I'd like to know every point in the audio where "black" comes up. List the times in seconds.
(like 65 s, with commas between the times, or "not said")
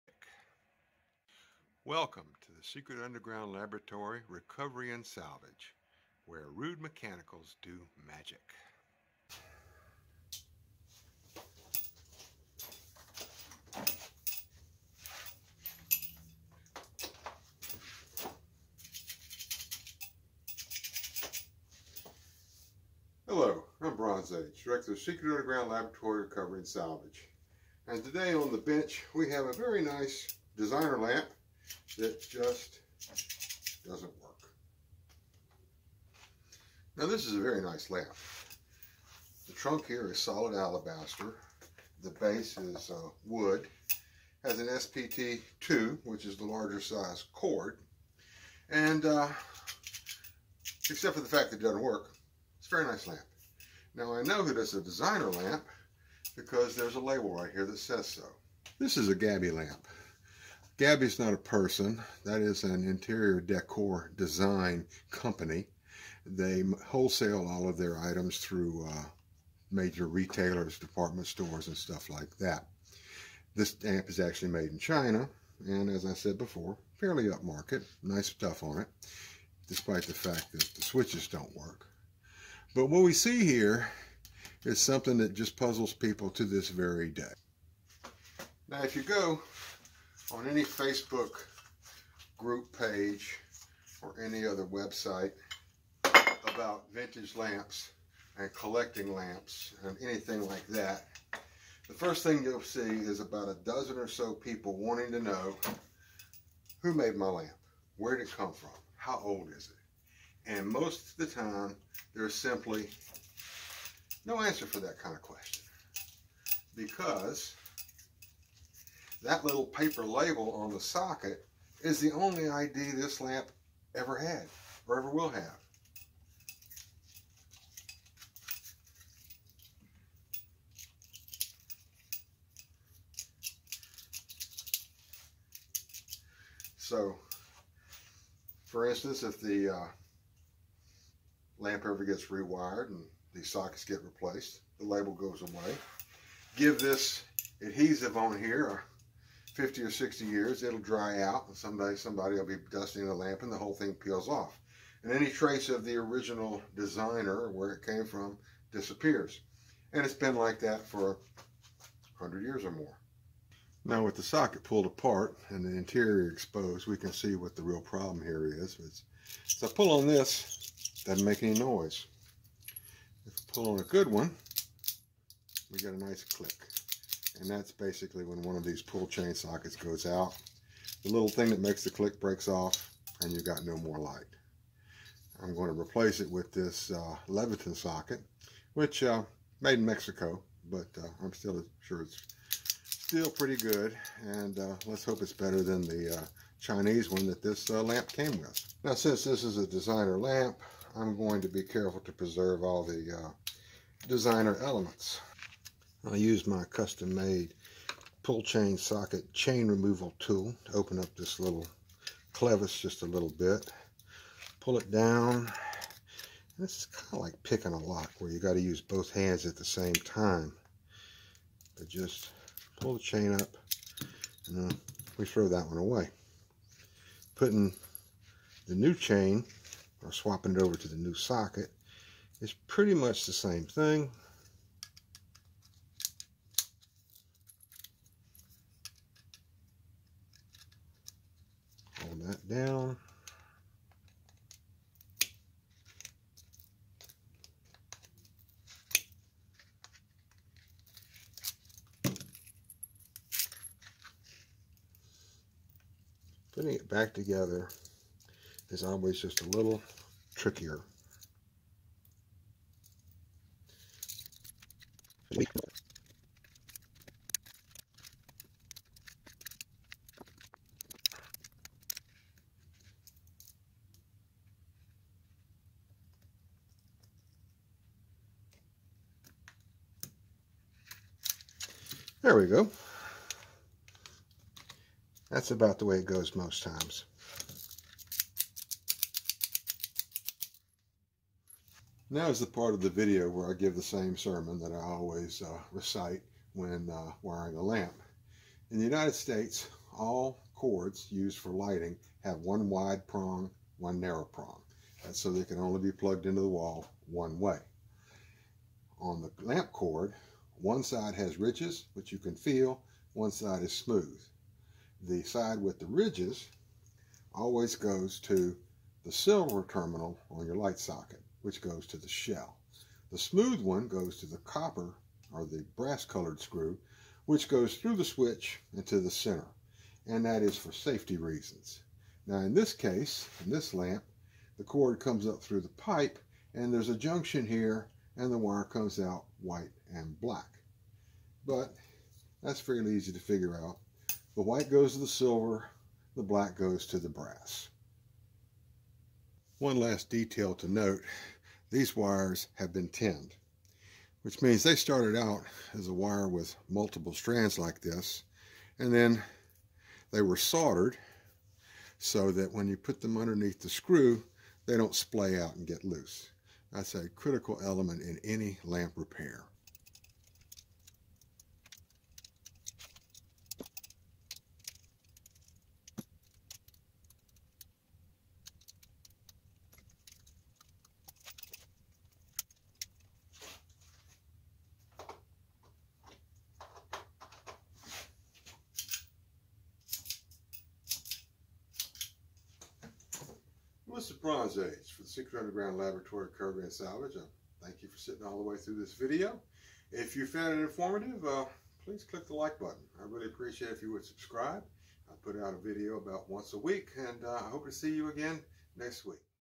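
340 s, 346 s.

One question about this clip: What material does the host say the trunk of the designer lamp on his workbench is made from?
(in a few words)
Alabaster.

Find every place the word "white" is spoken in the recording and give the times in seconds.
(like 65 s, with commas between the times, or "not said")
339 s, 344 s.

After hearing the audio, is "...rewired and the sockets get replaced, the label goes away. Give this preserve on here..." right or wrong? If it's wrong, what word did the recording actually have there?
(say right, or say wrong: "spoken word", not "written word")
wrong: "adhesive", not "preserve".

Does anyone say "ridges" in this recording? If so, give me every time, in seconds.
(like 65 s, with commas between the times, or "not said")
311 s, 315 s.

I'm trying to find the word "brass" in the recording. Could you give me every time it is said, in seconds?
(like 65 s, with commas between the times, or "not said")
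325 s, 347 s.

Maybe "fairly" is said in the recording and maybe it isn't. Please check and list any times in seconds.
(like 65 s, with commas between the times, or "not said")
76 s, 342 s.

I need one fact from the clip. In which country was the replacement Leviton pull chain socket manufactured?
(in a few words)
Mexico.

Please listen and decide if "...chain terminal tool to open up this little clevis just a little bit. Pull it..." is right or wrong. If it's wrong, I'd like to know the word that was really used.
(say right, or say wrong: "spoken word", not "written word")
wrong: "removal", not "terminal".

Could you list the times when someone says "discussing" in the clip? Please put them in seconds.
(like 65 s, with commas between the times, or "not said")
not said.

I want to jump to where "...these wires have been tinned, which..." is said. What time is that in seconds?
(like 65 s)
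351 s.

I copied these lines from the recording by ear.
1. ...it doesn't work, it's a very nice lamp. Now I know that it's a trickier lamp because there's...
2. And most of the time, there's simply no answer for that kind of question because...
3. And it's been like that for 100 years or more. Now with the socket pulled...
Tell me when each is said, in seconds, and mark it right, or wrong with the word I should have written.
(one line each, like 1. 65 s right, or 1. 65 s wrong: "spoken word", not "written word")
1. 51 s wrong: "designer", not "trickier"
2. 110 s right
3. 159 s right.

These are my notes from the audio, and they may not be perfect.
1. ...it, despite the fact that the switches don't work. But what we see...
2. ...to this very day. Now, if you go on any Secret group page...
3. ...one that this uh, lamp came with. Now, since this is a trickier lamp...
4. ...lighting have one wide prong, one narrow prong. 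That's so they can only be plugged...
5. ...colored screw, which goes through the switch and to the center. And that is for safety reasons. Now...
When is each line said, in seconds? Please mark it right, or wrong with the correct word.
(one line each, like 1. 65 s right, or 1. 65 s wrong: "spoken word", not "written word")
1. 78 s right
2. 86 s wrong: "Facebook", not "Secret"
3. 197 s wrong: "designer", not "trickier"
4. 301 s right
5. 326 s right.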